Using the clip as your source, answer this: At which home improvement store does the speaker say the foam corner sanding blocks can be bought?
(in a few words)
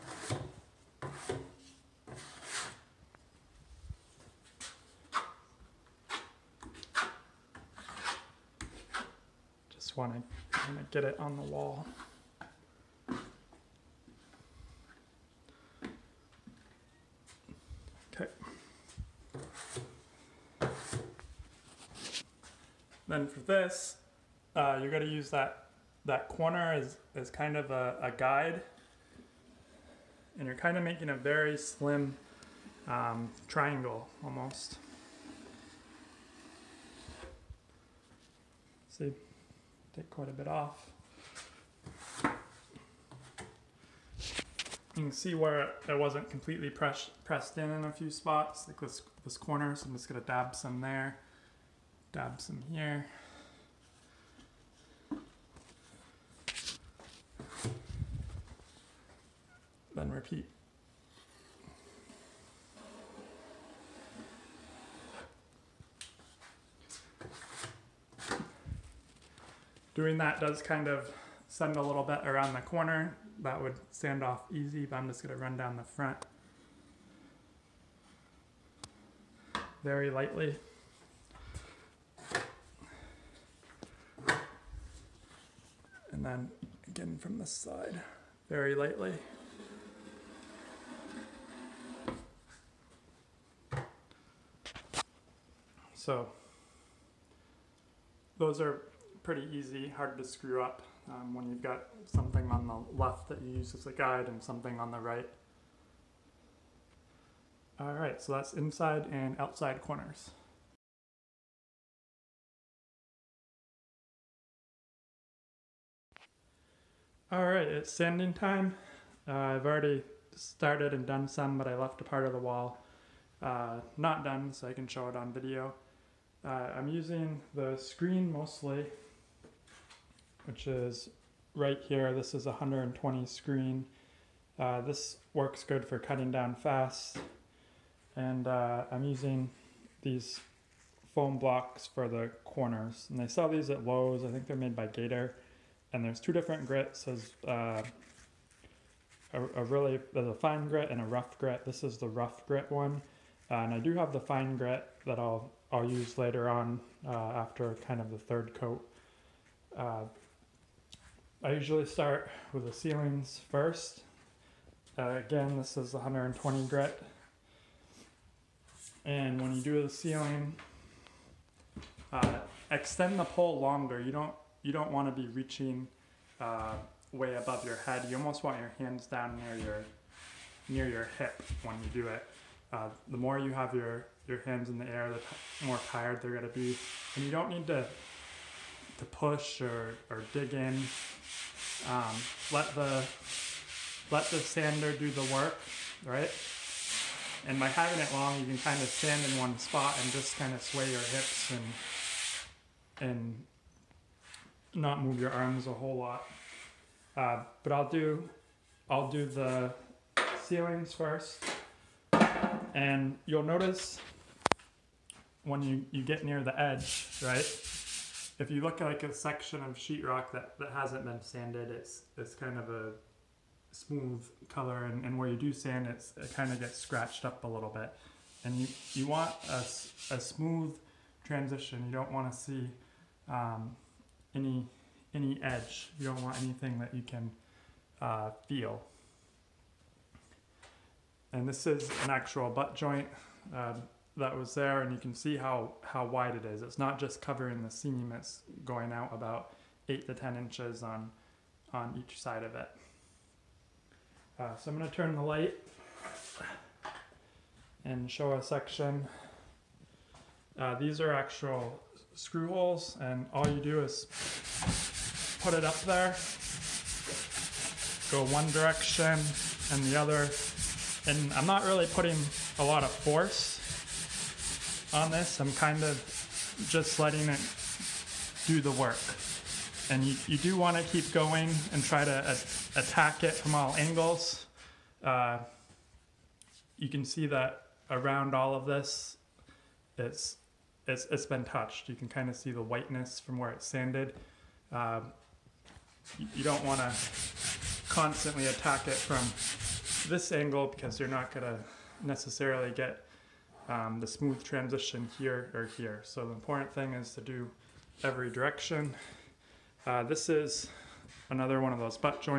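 Lowe's.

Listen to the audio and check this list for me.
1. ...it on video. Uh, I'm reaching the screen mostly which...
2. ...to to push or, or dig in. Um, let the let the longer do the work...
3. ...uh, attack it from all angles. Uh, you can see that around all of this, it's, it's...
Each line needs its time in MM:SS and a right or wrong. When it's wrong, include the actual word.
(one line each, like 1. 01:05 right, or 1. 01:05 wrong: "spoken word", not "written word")
1. 02:05 wrong: "using", not "reaching"
2. 03:07 wrong: "sander", not "longer"
3. 04:42 right.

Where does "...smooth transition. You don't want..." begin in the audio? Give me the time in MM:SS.
03:50.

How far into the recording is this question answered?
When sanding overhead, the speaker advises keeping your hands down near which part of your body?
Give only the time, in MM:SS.
03:01.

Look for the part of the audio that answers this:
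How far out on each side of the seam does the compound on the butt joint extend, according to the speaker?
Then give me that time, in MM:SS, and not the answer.
04:09.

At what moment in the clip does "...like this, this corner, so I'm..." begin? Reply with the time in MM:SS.
00:48.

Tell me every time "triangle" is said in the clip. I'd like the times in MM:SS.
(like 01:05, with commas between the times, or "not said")
00:33.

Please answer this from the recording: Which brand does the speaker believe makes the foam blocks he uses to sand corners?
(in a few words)
Gator.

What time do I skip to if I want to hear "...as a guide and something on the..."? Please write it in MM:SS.
01:43.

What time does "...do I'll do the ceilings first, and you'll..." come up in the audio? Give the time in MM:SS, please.
03:27.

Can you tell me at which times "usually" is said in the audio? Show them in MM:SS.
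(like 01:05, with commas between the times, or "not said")
02:41.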